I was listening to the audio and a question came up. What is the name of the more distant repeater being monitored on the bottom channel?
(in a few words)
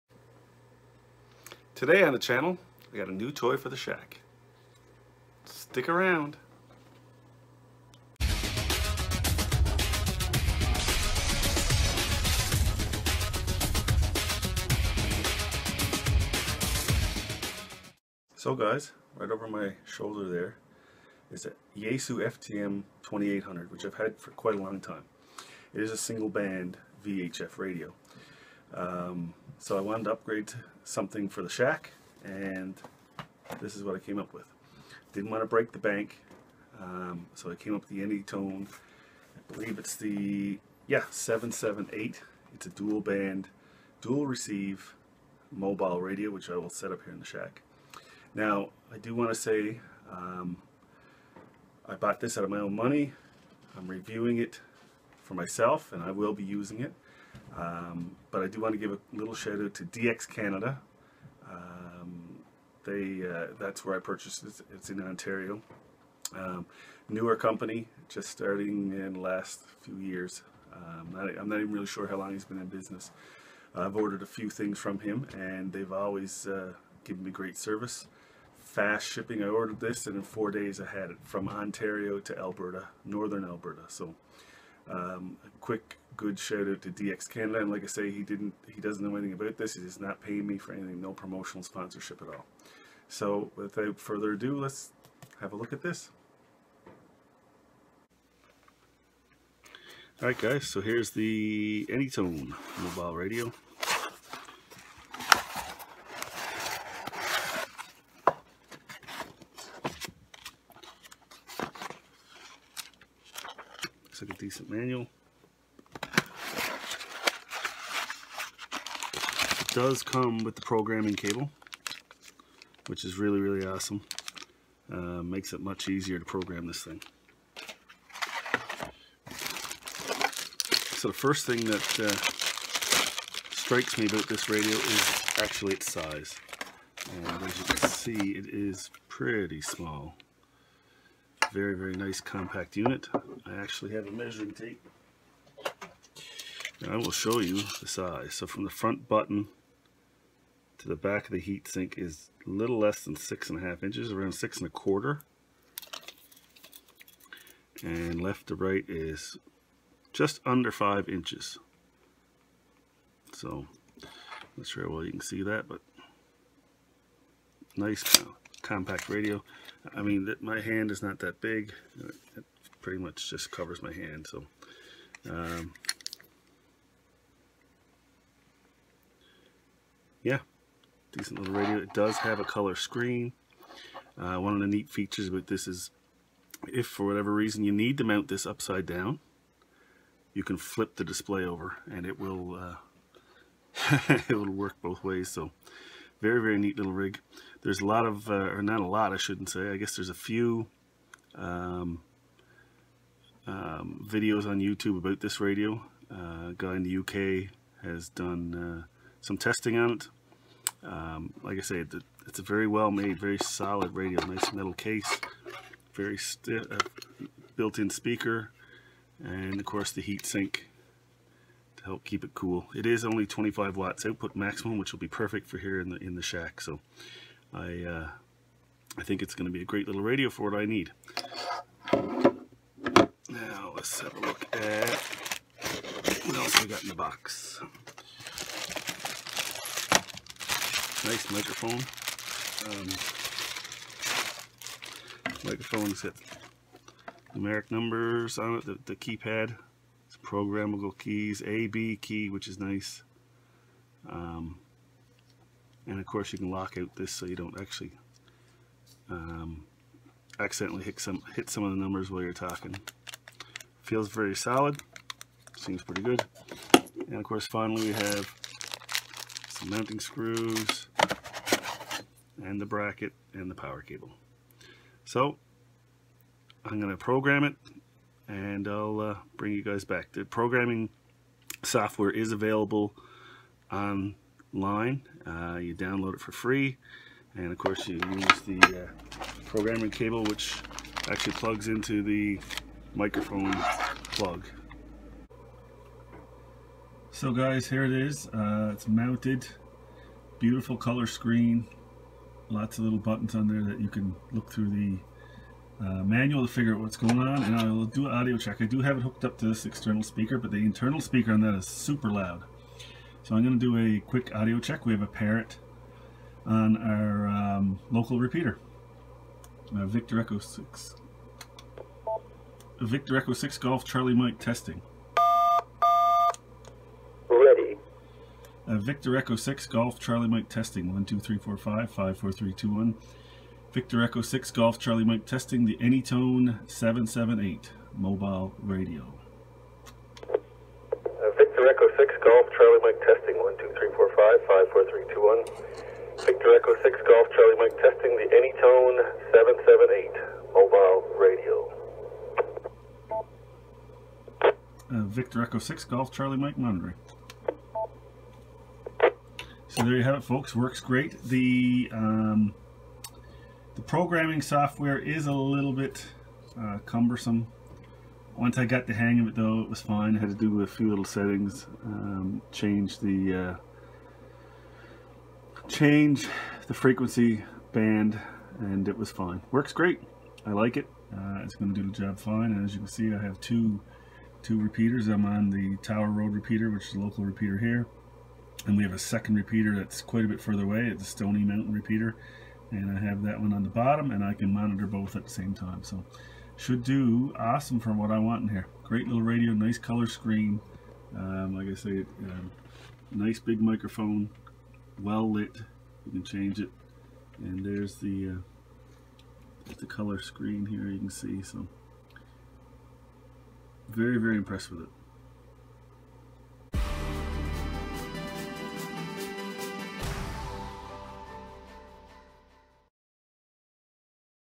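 Stony Mountain.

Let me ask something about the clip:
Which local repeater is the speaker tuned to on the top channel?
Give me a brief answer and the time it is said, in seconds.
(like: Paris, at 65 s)
Tower Road, at 385 s.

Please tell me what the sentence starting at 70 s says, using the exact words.
Um, not, I'm not even really sure how long he's been in business.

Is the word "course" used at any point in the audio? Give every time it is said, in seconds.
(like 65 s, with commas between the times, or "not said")
219 s, 256 s, 267 s, 287 s.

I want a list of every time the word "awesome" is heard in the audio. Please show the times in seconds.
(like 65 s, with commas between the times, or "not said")
123 s, 397 s.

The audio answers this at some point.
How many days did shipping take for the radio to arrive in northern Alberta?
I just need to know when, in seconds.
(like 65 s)
80 s.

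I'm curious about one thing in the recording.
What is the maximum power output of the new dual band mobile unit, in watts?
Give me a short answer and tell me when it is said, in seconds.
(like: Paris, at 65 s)
25, at 223 s.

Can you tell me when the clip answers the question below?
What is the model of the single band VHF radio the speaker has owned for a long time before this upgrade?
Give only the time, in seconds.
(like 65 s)
21 s.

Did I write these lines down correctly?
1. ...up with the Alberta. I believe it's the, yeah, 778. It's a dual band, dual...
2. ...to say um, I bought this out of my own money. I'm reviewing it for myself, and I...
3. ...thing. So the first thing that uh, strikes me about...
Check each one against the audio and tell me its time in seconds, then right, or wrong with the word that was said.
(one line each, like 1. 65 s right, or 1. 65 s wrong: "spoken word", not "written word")
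1. 37 s wrong: "Anytone", not "Alberta"
2. 49 s right
3. 126 s right.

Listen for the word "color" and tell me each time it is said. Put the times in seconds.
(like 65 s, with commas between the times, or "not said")
182 s, 300 s, 399 s, 409 s.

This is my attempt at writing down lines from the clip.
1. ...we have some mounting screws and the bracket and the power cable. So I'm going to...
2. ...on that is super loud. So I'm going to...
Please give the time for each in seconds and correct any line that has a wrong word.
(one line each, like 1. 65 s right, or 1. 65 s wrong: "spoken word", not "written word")
1. 267 s right
2. 311 s right.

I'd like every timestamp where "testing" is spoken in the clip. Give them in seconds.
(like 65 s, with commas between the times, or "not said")
209 s, 324 s, 330 s, 335 s, 342 s, 347 s.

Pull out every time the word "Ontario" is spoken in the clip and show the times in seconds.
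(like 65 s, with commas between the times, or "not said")
65 s, 81 s.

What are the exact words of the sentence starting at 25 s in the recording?
It is a single band VHF radio.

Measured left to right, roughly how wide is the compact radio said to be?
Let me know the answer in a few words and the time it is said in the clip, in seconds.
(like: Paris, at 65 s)
just under 5 inches, at 160 s.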